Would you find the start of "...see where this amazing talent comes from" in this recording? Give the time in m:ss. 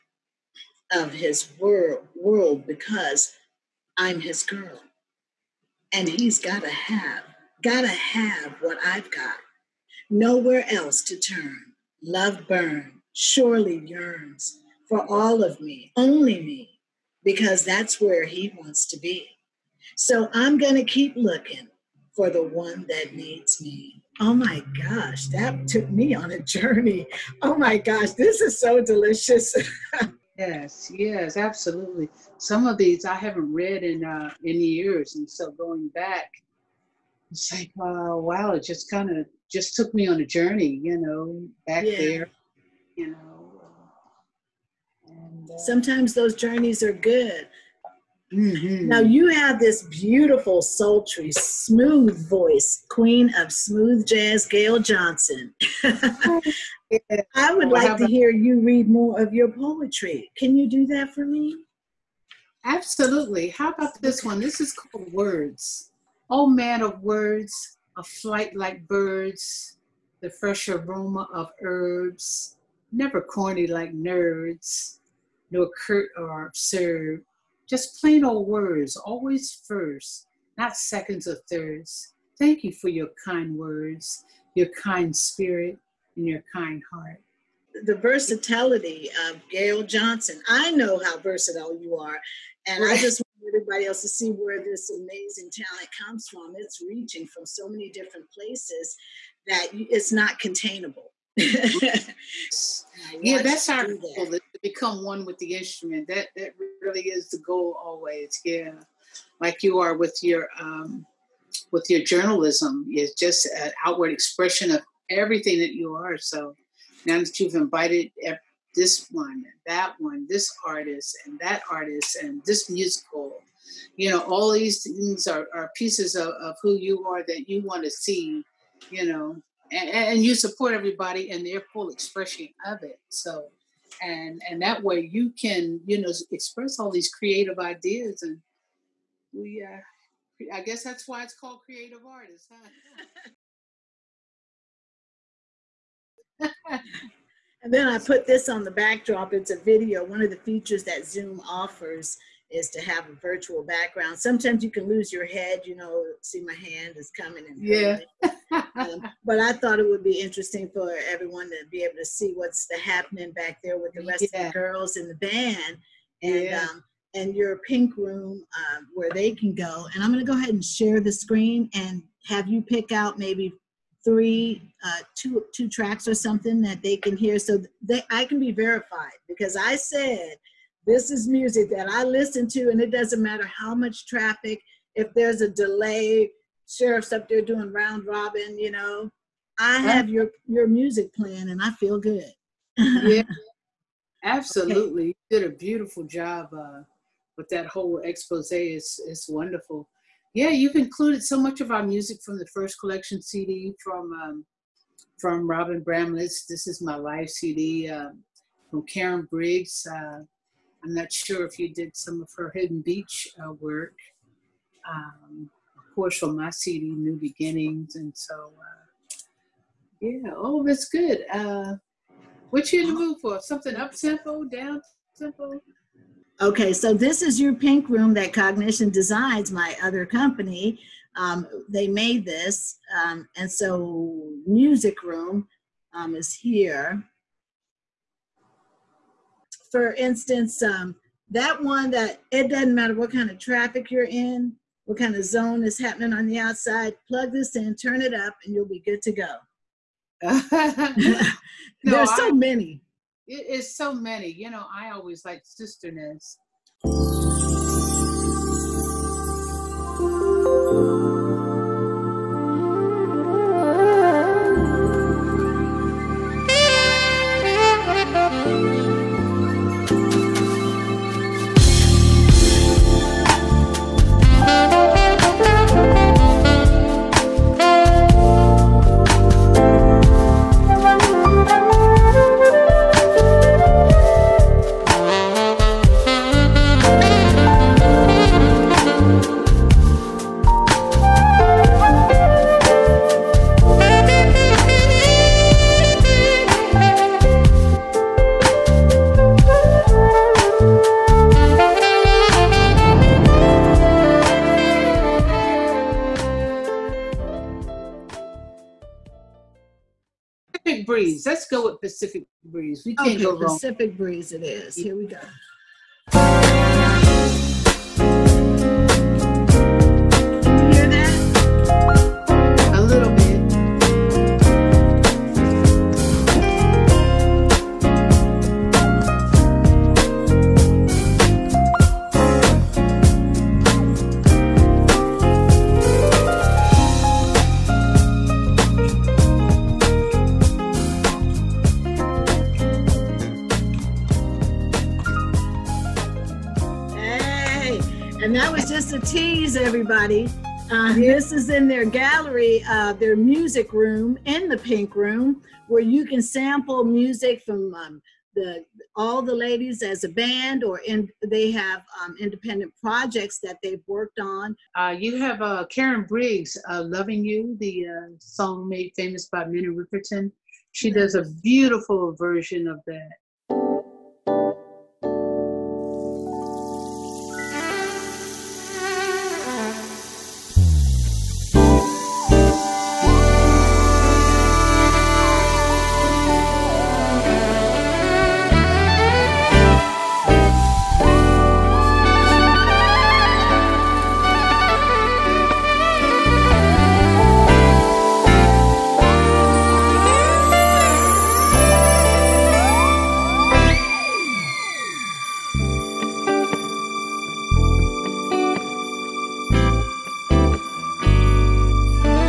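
1:34.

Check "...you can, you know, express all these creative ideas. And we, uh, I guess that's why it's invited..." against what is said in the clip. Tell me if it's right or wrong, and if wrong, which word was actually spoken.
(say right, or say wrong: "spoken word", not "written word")
wrong: "called", not "invited".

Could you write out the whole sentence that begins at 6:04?
Uh, you have uh, Karen Briggs, uh, "Loving You," the uh, song made famous by Minnie Riperton.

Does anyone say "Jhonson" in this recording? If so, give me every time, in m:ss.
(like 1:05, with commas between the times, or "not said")
0:54, 1:29.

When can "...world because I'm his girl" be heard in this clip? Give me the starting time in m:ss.
0:02.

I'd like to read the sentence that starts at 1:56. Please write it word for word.
So now that you've invited this one, that one, this artist, and that artist, and this musical.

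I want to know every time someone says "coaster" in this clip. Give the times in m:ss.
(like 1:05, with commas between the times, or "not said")
not said.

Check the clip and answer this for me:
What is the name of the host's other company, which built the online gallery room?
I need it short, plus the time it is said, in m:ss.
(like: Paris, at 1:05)
Cognition Designs, at 3:48.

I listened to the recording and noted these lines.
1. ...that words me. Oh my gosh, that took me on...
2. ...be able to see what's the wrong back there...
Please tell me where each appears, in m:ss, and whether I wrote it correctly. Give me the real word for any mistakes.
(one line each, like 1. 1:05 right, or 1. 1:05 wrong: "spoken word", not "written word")
1. 0:22 wrong: "needs", not "words"
2. 2:41 wrong: "happening", not "wrong".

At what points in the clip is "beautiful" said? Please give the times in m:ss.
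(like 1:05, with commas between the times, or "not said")
0:49, 3:15, 6:11.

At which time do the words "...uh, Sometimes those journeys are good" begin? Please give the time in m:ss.
0:45.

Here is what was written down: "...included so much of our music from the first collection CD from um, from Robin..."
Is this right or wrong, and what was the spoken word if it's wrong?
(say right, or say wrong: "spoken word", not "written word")
right.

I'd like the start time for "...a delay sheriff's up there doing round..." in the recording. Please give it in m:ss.
3:05.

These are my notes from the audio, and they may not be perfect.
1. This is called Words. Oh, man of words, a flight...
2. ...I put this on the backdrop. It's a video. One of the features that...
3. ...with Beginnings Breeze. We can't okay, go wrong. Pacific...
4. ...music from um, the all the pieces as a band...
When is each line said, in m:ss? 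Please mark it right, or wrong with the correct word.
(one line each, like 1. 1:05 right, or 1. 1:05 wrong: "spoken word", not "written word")
1. 1:04 right
2. 2:27 right
3. 5:11 wrong: "Pacific", not "Beginnings"
4. 5:56 wrong: "ladies", not "pieces".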